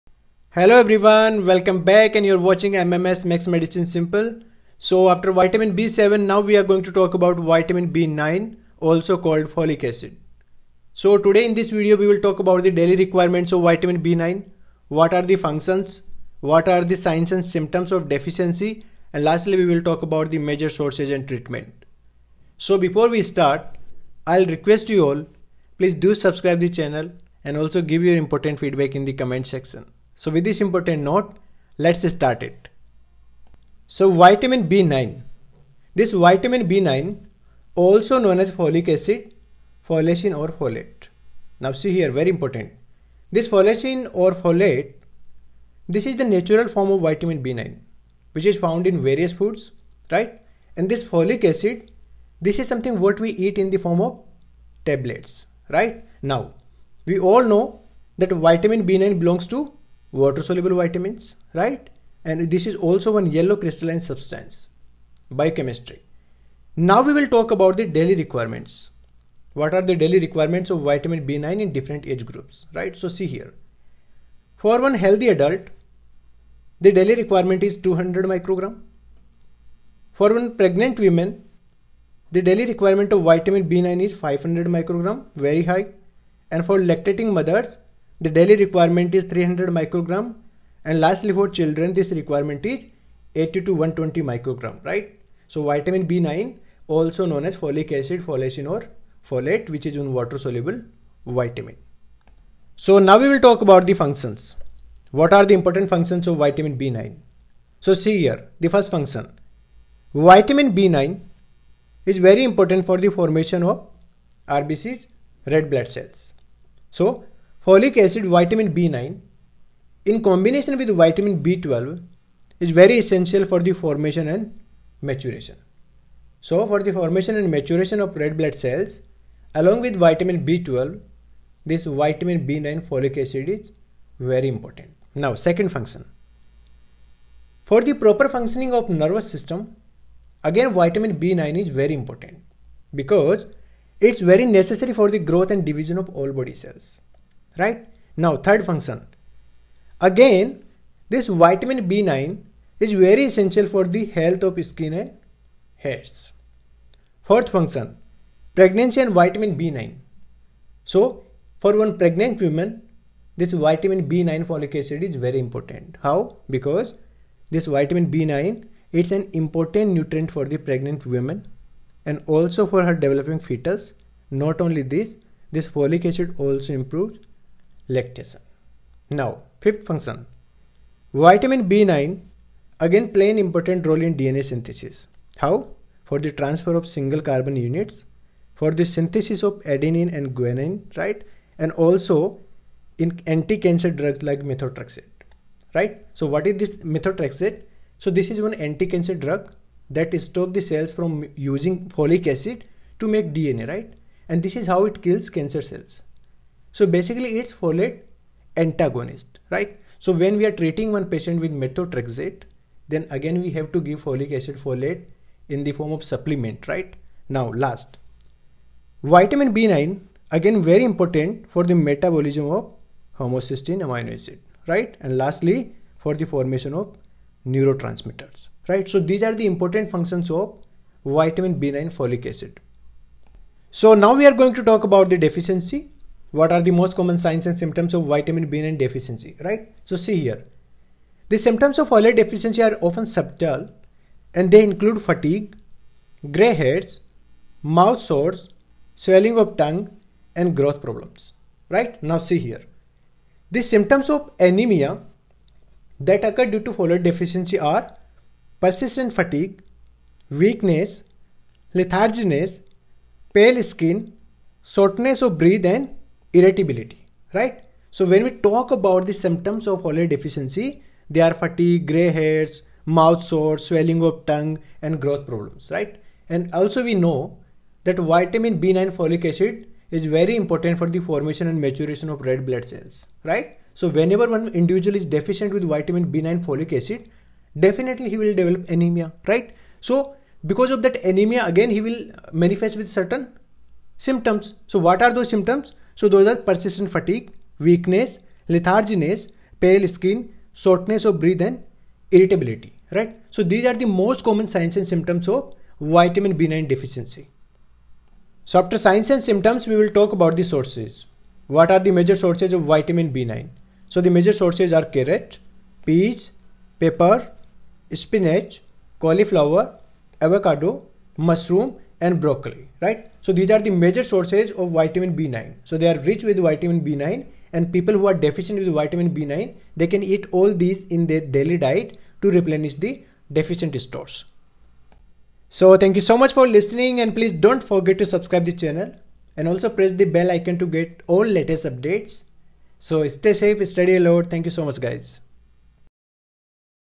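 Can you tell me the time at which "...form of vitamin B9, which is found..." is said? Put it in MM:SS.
00:46.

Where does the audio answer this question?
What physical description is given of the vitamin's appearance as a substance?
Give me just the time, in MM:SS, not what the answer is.
01:03.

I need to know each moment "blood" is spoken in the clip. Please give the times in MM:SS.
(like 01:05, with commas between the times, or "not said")
01:55, 02:08, 04:42.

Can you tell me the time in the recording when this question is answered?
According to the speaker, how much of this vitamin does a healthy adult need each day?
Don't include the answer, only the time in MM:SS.
01:17.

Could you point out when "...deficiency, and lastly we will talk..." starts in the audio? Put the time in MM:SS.
00:18.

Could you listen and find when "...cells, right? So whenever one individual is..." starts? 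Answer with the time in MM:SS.
04:42.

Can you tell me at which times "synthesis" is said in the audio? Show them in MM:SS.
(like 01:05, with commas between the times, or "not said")
03:04, 03:08.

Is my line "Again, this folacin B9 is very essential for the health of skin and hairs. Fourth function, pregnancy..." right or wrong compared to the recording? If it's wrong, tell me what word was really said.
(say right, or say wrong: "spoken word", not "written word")
wrong: "vitamin", not "folacin".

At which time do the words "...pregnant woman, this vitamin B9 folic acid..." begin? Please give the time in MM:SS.
02:41.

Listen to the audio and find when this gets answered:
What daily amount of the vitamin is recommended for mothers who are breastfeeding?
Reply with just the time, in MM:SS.
01:29.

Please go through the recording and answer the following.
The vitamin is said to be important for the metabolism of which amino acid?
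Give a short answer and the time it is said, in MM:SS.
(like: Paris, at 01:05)
Homocysteine, at 03:43.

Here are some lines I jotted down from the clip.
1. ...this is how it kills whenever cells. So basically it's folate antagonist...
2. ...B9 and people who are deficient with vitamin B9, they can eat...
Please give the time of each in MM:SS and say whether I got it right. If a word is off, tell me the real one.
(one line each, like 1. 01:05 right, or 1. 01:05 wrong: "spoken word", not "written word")
1. 03:24 wrong: "cancer", not "whenever"
2. 05:26 right.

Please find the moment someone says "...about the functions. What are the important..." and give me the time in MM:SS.
01:43.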